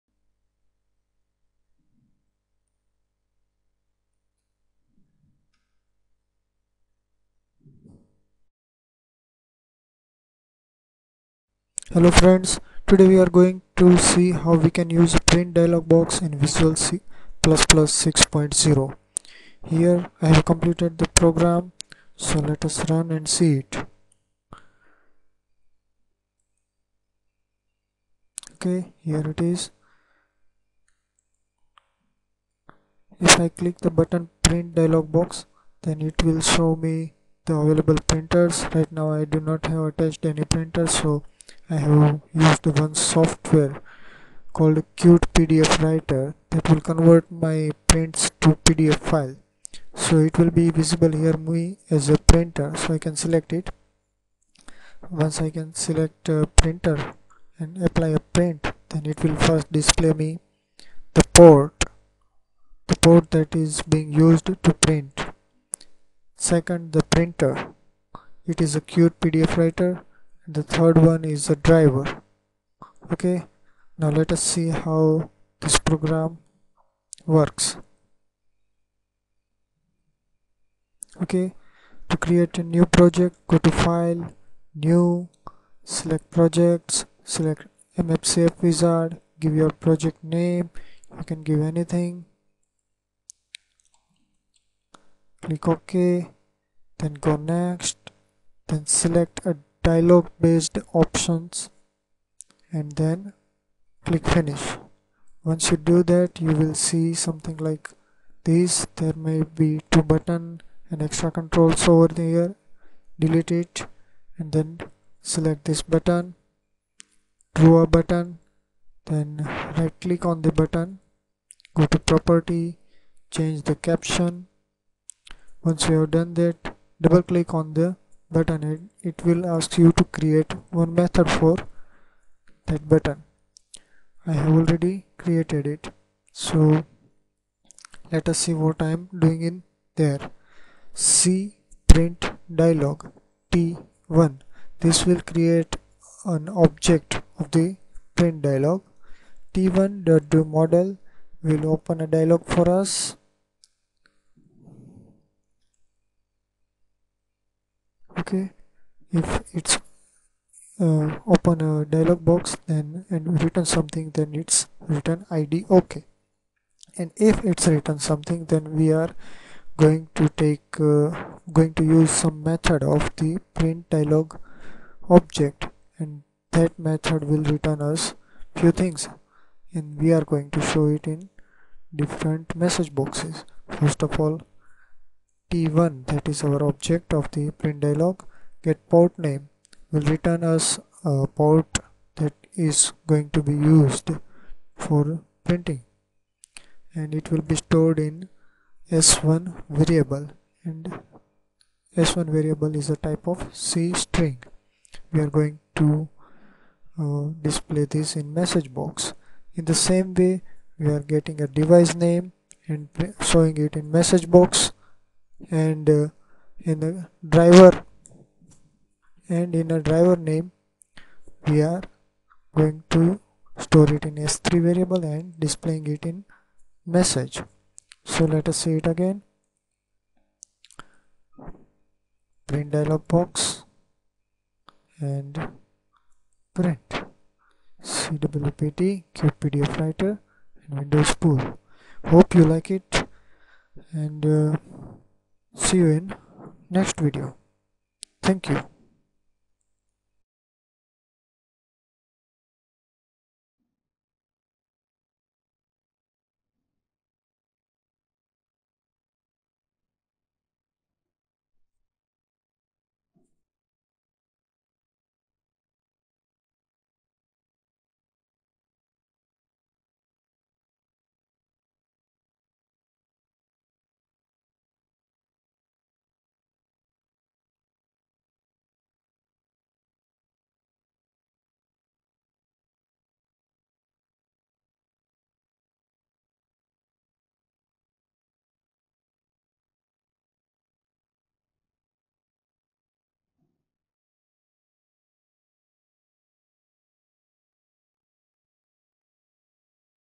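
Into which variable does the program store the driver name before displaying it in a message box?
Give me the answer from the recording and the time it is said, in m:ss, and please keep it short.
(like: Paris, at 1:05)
s3, at 3:44.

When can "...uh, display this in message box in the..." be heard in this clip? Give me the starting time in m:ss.
3:27.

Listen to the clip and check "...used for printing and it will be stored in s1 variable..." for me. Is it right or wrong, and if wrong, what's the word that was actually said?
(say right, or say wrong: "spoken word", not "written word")
right.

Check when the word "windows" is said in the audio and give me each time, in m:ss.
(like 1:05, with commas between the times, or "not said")
4:00.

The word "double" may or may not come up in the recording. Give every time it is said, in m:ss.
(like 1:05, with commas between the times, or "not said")
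2:07.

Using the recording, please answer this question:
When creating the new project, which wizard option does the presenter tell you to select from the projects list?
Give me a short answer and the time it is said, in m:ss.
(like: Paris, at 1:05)
MFC AppWizard, at 1:28.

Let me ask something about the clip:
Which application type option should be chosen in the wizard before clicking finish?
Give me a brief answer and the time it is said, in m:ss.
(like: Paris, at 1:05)
dialog based, at 1:39.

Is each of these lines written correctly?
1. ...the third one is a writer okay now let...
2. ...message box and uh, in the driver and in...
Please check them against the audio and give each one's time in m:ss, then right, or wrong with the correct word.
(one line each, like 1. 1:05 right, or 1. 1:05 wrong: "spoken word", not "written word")
1. 1:10 wrong: "driver", not "writer"
2. 3:33 right.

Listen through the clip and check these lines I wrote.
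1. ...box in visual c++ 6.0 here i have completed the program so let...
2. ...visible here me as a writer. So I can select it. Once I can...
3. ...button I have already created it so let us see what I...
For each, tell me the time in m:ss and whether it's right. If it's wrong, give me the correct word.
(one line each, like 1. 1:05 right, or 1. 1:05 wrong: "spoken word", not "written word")
1. 0:15 right
2. 0:50 wrong: "printer", not "writer"
3. 2:12 right.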